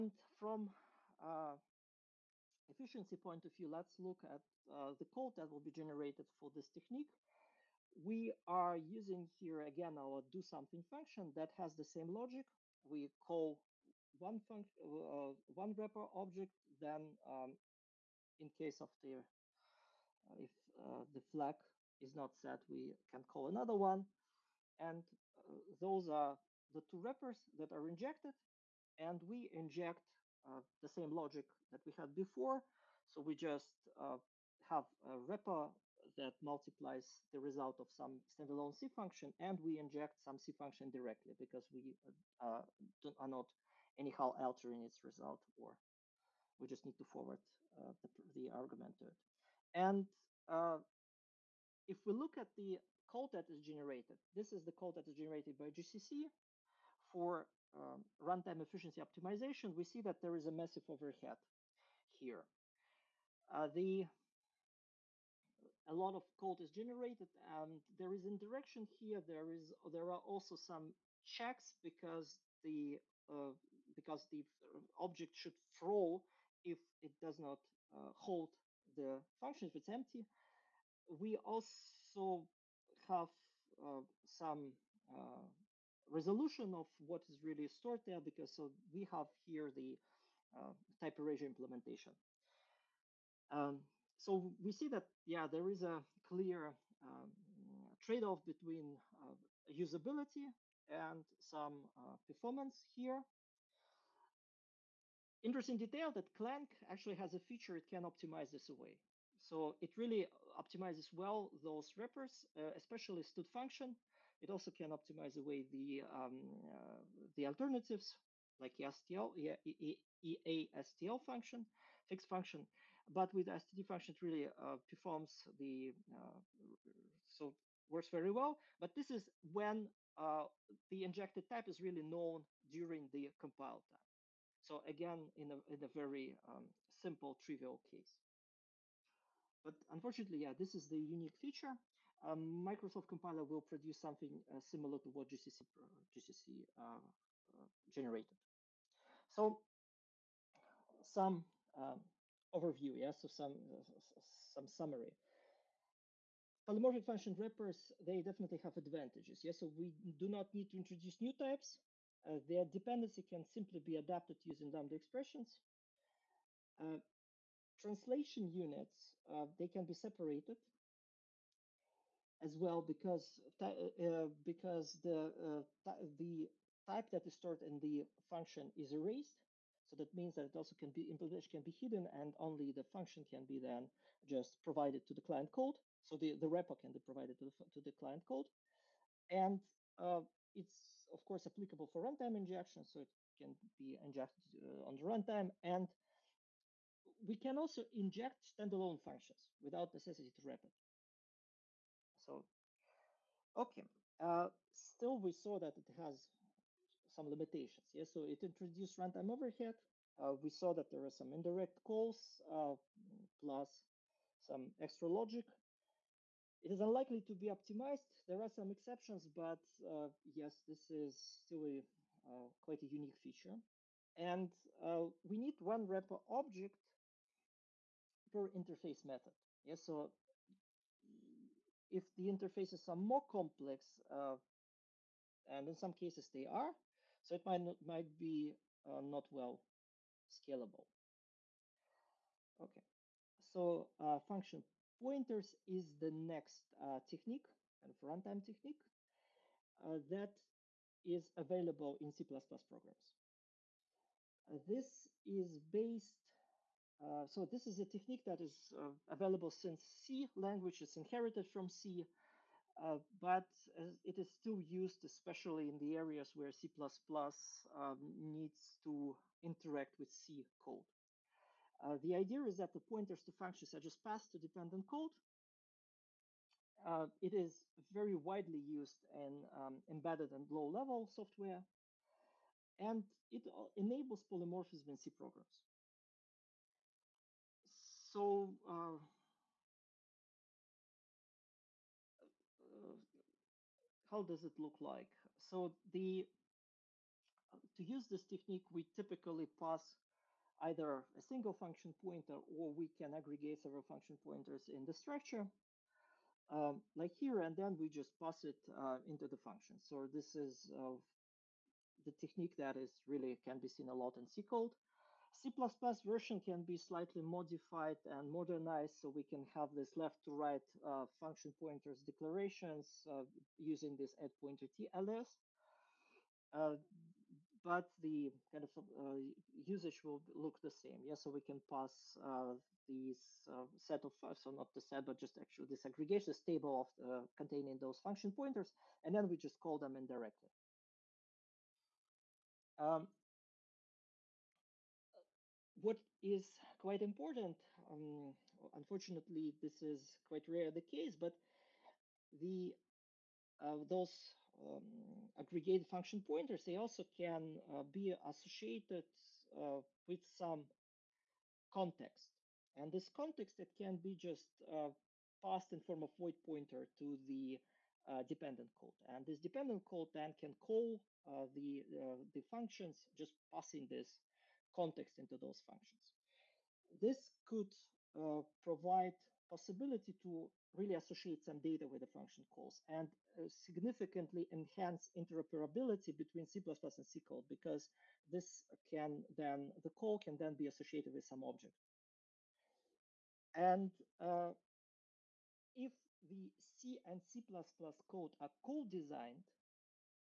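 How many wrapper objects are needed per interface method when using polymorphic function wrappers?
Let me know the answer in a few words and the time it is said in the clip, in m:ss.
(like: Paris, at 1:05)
1, at 3:45.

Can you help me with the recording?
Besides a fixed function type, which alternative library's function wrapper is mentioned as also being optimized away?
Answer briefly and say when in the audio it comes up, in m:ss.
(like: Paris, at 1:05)
EASTL, at 2:00.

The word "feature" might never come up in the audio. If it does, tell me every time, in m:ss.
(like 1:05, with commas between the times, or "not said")
1:47, 2:21, 3:43.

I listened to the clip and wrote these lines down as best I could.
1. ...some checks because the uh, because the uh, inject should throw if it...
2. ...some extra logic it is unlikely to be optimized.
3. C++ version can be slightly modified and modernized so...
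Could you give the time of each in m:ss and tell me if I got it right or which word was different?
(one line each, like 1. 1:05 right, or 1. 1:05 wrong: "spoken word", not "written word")
1. 1:10 wrong: "object", not "inject"
2. 3:34 right
3. 5:15 right.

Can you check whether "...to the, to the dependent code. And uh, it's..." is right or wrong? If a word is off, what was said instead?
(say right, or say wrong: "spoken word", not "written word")
wrong: "client", not "dependent".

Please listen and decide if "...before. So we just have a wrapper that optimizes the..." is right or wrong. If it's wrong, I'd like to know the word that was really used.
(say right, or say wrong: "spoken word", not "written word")
wrong: "multiplies", not "optimizes".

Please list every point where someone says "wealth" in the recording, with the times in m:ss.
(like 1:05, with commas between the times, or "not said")
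not said.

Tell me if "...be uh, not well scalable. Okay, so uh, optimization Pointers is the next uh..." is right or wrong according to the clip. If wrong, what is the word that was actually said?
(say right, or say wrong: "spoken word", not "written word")
wrong: "function", not "optimization".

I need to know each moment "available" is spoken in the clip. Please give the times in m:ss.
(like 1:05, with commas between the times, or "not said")
4:11, 4:19.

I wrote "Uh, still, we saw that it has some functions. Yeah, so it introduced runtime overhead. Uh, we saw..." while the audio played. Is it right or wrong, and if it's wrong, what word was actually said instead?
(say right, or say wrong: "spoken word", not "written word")
wrong: "limitations", not "functions".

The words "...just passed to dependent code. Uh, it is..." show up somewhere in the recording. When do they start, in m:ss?
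4:33.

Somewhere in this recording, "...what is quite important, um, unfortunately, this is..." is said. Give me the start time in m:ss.
5:45.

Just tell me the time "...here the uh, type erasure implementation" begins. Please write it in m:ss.
1:29.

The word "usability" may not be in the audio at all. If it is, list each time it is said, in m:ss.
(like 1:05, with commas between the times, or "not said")
1:39.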